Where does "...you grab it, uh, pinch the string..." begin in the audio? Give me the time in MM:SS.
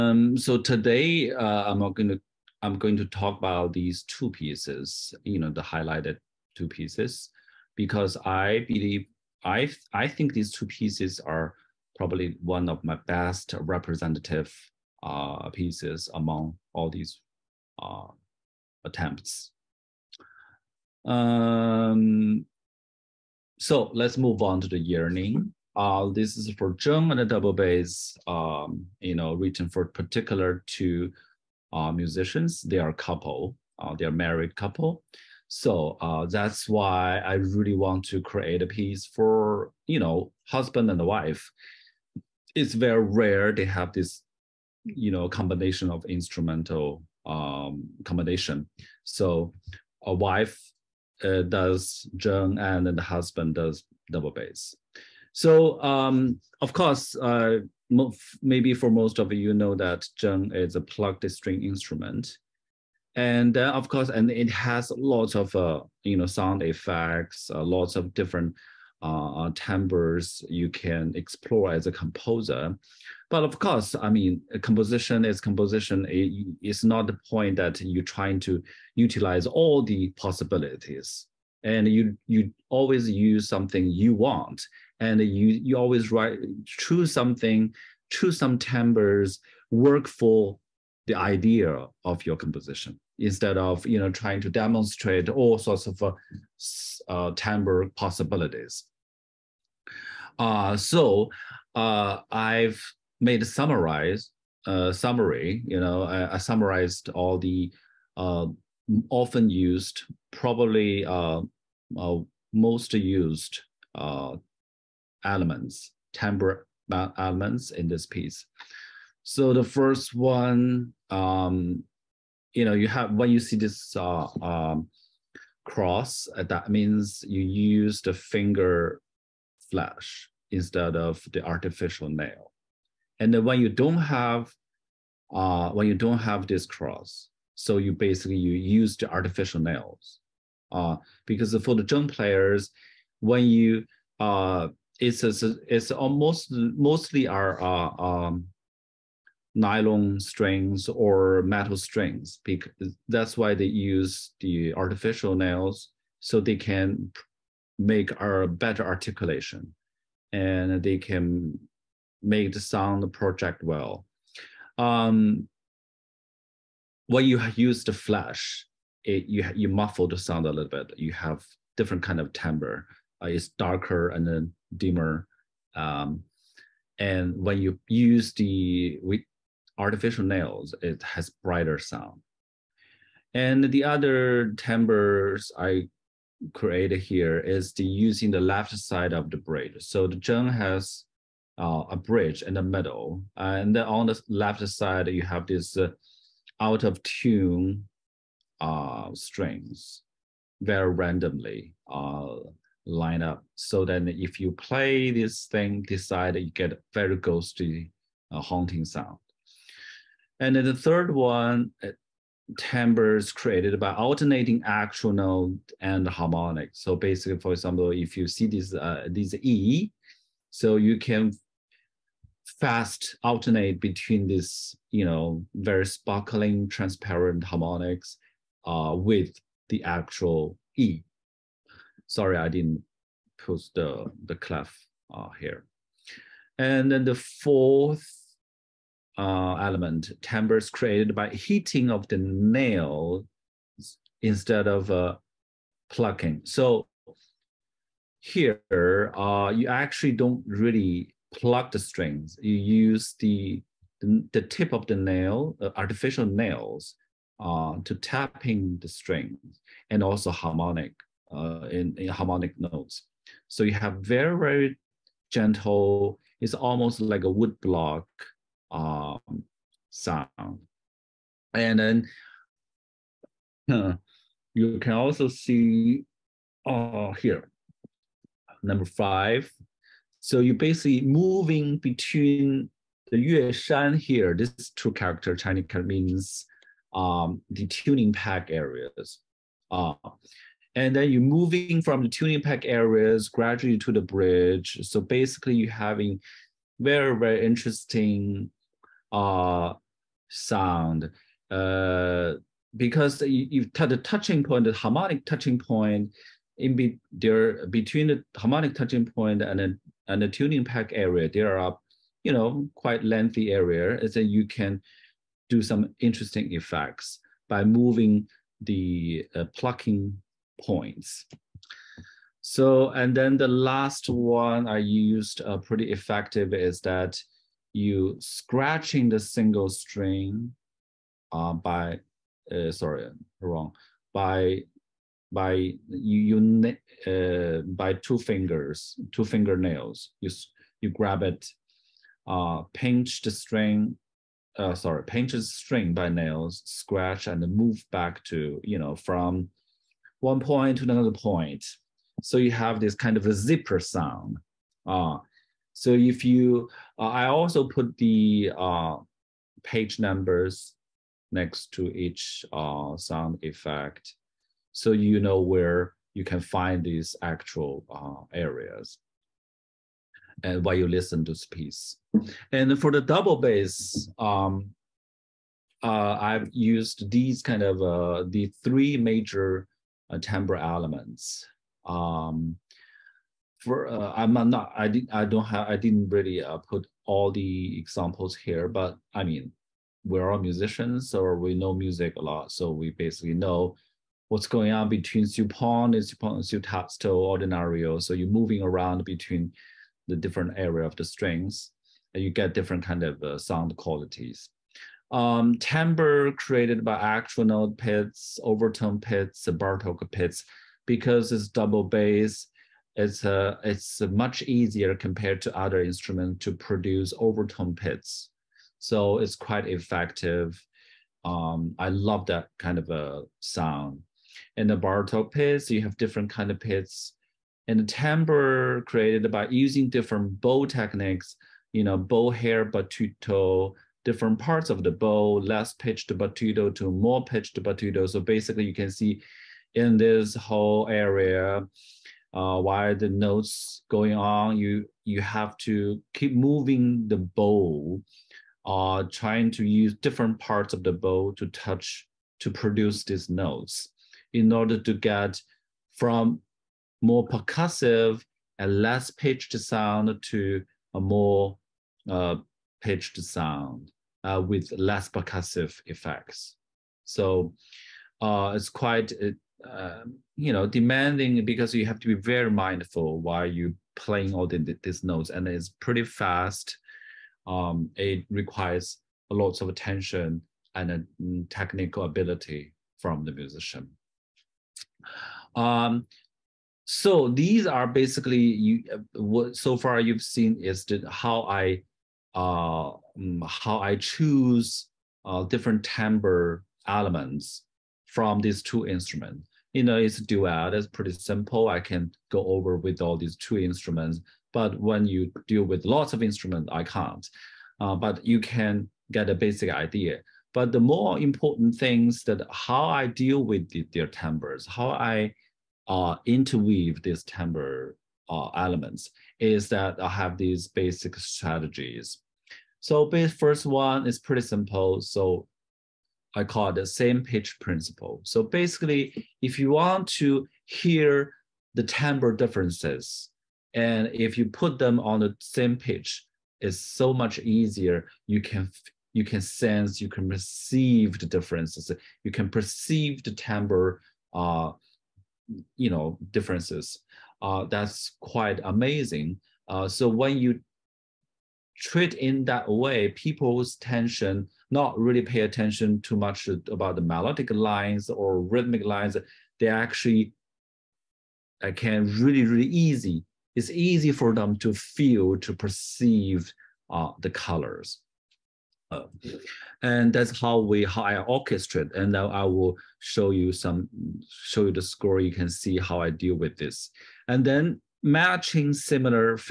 05:40.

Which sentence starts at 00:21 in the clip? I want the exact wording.
Um, so let's move on to the yearning.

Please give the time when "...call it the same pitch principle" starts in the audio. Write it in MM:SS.
08:46.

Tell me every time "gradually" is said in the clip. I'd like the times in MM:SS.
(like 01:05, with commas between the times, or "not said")
04:53.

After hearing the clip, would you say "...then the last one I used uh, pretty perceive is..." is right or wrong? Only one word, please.
wrong.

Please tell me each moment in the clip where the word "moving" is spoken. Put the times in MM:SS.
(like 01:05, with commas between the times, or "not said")
04:41, 04:51, 05:17, 06:38, 07:26.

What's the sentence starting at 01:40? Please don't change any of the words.
Uh, so uh, I've made a summarize uh, summary.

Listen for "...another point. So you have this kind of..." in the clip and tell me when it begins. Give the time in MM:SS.
05:50.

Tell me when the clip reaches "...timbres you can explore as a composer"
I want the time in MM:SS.
01:09.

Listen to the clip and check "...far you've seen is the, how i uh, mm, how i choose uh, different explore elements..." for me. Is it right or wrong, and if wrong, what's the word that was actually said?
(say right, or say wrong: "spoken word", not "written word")
wrong: "timbre", not "explore".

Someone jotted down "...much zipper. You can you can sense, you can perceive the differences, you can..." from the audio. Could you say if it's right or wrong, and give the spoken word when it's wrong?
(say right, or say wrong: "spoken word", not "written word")
wrong: "easier", not "zipper".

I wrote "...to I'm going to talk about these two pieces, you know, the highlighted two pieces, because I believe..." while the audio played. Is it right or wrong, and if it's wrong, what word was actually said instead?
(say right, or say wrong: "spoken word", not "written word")
right.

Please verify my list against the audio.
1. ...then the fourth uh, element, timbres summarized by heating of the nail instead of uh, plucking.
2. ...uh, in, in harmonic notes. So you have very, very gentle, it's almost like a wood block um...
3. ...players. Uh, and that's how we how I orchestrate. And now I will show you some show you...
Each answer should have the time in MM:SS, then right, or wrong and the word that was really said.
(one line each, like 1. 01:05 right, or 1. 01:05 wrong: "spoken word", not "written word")
1. 03:56 wrong: "created", not "summarized"
2. 04:21 right
3. 09:27 wrong: "colors", not "players".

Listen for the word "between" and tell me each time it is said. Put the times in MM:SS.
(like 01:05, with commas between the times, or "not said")
03:43, 04:41, 05:07, 06:34, 06:39.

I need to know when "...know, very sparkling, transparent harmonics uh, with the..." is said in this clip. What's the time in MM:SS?
03:45.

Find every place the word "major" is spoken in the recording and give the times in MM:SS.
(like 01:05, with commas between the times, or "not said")
06:18.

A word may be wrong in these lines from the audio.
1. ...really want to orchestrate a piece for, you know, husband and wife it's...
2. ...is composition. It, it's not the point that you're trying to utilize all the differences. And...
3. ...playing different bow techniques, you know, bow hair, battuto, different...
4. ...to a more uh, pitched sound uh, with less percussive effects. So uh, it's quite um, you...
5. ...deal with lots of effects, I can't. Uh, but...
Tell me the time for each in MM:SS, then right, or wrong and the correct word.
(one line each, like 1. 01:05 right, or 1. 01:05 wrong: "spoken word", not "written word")
1. 00:37 wrong: "create", not "orchestrate"
2. 01:15 wrong: "possibilities", not "differences"
3. 07:09 wrong: "using", not "playing"
4. 07:40 right
5. 08:25 wrong: "instruments", not "effects".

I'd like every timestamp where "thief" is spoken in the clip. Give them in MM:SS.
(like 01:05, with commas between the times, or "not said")
not said.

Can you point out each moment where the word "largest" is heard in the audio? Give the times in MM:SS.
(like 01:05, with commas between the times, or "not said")
not said.